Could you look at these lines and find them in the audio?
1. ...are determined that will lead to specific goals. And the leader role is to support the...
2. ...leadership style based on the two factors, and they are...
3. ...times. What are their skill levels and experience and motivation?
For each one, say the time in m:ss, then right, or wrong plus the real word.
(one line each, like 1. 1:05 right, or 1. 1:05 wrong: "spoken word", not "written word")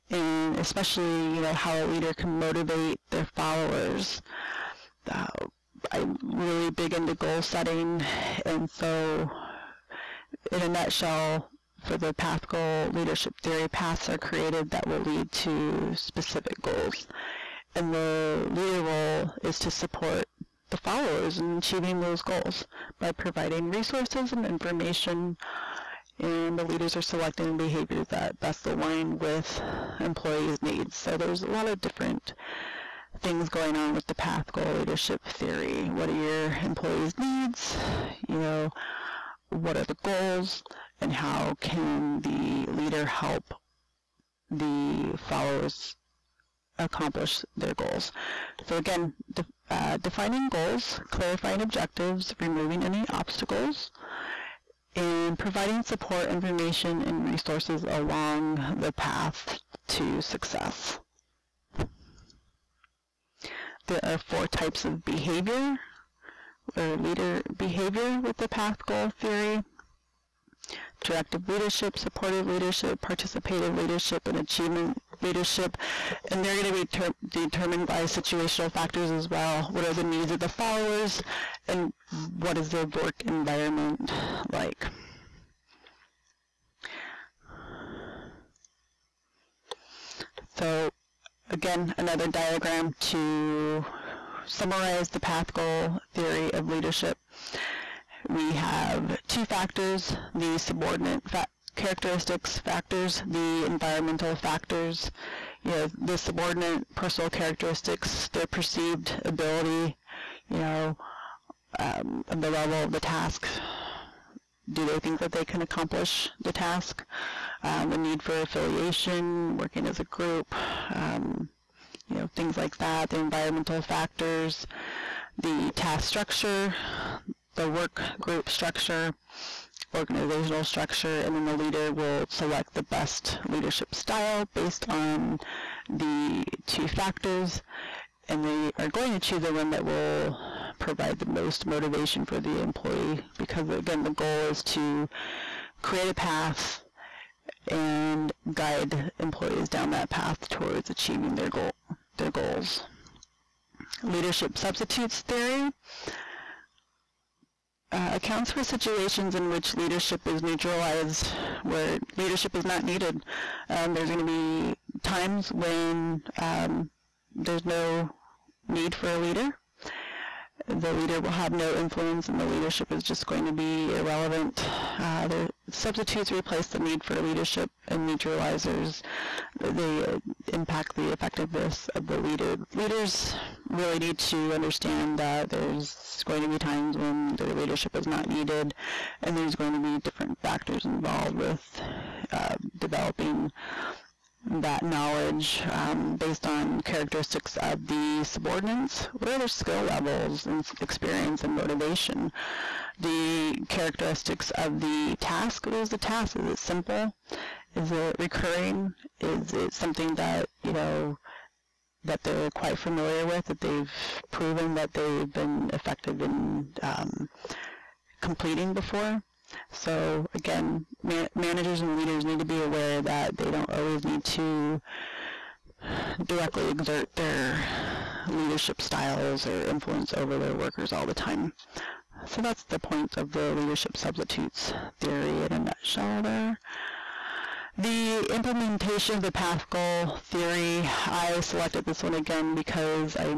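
1. 0:14 wrong: "created", not "determined"
2. 2:13 right
3. 3:18 wrong: "subordinates", not "times".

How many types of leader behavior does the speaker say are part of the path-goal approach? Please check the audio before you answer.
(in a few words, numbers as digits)
4.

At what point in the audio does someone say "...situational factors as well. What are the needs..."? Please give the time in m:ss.
1:18.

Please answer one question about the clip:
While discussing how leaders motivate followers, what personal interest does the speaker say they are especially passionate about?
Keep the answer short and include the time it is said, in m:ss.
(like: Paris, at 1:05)
Goal setting, at 0:07.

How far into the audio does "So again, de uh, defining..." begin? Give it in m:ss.
0:48.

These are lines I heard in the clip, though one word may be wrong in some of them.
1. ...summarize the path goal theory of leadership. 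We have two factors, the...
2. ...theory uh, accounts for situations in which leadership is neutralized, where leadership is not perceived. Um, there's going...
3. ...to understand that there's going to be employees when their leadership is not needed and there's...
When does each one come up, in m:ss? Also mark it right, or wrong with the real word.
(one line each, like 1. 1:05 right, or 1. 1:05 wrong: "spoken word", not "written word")
1. 1:34 right
2. 2:35 wrong: "needed", not "perceived"
3. 3:04 wrong: "times", not "employees".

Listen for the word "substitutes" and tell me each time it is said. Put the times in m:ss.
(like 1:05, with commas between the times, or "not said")
2:34, 2:55, 3:53.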